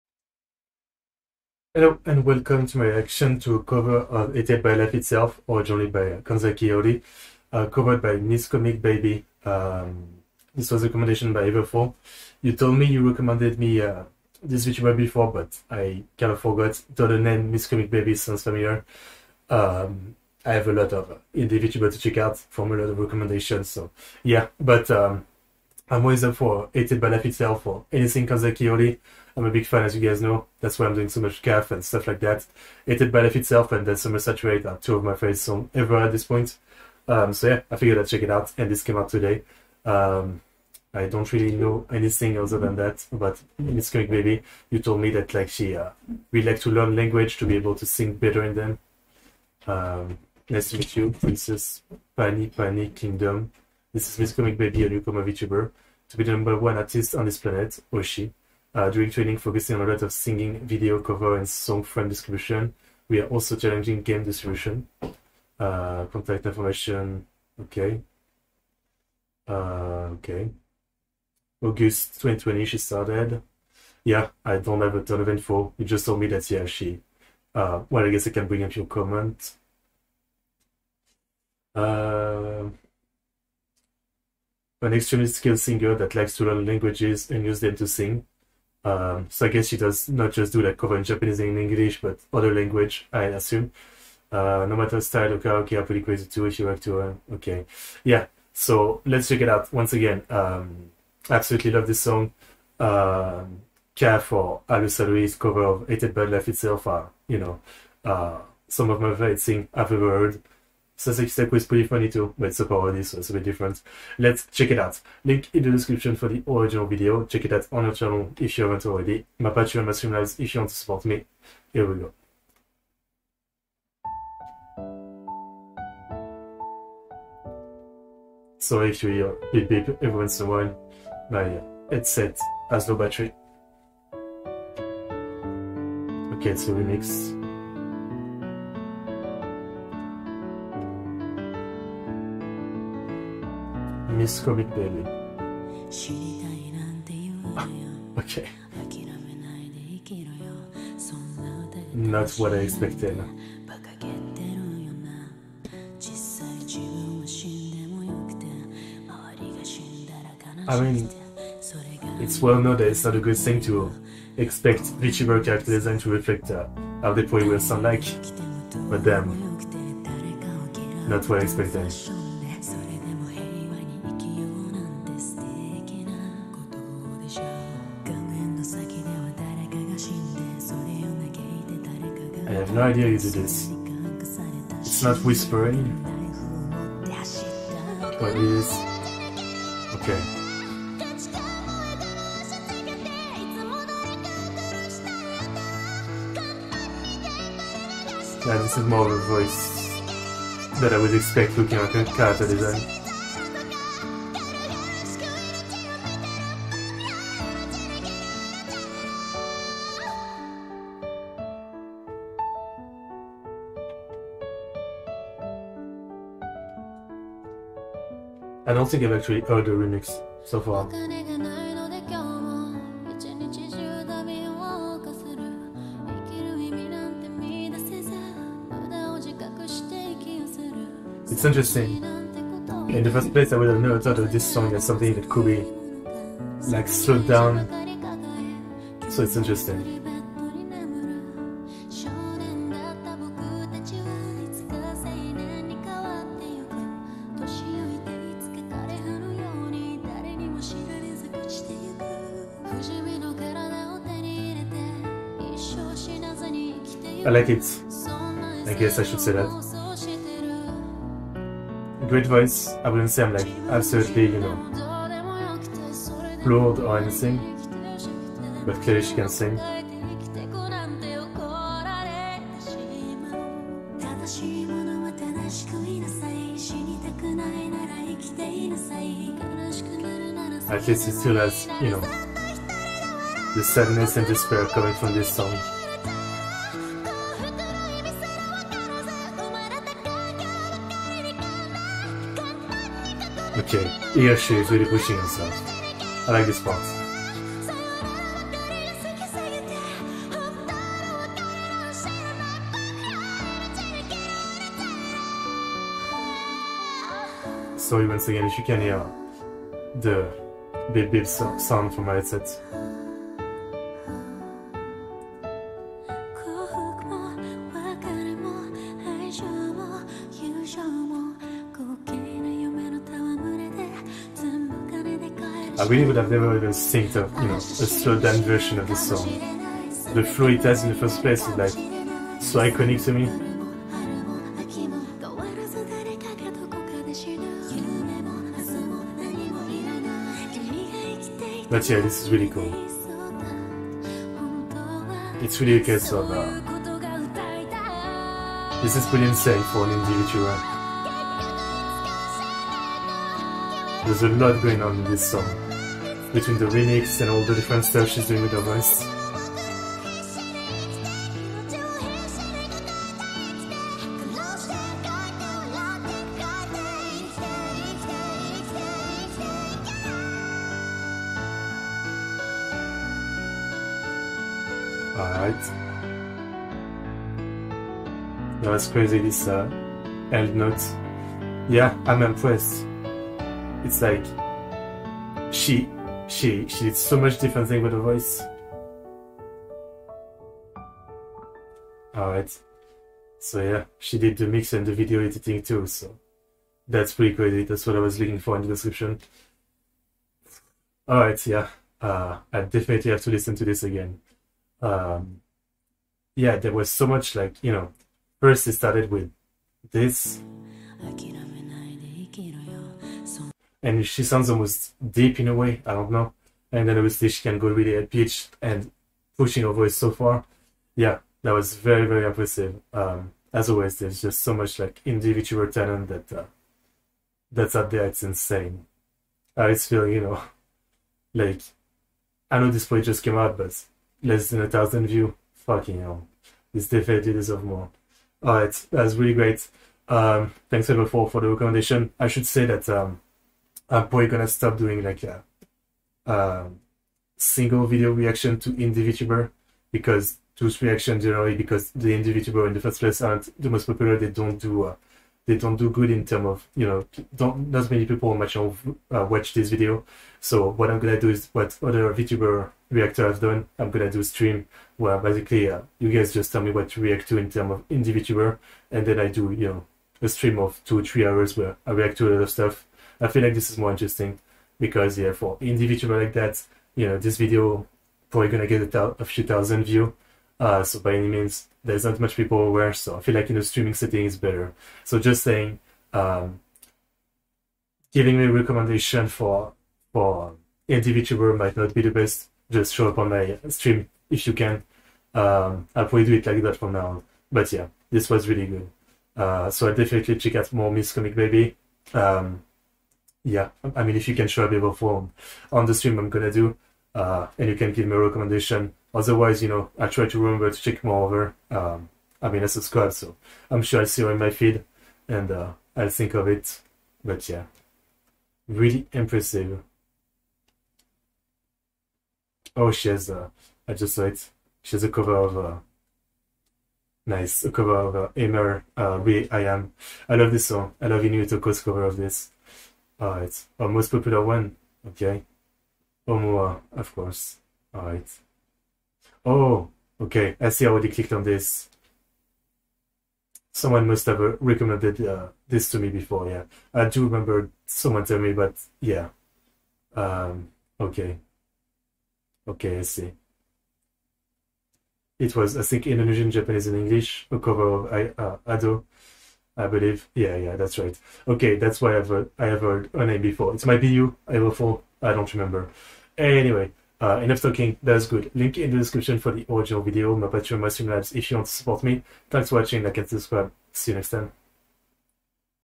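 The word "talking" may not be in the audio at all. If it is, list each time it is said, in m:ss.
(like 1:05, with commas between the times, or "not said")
9:27.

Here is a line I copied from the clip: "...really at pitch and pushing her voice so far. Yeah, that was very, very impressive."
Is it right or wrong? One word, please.
right.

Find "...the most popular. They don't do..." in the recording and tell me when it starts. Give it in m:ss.
7:33.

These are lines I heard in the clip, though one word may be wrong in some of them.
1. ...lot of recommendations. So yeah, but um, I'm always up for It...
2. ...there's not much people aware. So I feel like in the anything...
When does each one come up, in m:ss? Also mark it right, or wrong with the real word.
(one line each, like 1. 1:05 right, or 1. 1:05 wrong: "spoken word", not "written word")
1. 0:22 right
2. 8:01 wrong: "streaming", not "anything".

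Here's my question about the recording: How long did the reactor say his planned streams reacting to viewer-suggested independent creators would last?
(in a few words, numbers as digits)
2-3 hours.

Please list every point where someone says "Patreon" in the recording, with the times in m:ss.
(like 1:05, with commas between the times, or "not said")
1:59, 9:30.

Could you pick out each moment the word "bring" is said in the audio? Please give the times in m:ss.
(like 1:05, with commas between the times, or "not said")
1:18.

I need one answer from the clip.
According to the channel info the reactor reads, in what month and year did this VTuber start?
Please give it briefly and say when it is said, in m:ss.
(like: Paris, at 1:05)
August 2020, at 1:11.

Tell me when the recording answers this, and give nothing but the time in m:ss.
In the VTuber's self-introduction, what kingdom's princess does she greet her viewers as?
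0:52.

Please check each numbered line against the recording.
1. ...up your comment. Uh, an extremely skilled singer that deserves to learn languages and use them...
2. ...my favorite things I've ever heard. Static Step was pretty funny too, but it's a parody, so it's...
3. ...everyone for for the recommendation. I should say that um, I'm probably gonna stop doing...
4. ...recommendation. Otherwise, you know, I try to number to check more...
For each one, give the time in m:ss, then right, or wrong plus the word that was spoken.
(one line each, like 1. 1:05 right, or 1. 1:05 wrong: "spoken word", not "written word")
1. 1:18 wrong: "likes", not "deserves"
2. 1:49 right
3. 7:20 right
4. 8:28 wrong: "remember", not "number".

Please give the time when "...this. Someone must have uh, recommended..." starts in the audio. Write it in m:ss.
9:01.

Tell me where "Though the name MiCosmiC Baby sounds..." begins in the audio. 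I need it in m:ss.
0:16.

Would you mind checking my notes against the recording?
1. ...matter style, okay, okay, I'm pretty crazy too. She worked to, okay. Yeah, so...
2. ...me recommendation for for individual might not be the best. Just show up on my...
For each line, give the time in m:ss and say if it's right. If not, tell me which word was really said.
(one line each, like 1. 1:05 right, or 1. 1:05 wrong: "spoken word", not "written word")
1. 1:34 right
2. 8:08 right.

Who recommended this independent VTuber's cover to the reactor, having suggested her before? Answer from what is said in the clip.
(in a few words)
Everfall.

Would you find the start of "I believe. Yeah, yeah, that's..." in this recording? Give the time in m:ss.
9:19.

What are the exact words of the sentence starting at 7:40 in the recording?
So what I'm gonna do is what other VTuber reactor have done.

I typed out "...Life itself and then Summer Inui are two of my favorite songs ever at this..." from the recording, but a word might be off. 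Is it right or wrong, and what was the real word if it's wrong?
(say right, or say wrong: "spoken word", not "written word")
wrong: "Saturate", not "Inui".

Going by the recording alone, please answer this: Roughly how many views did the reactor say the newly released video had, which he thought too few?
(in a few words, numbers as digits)
Less than 1,000.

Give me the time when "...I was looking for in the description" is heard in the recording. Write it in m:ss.
6:37.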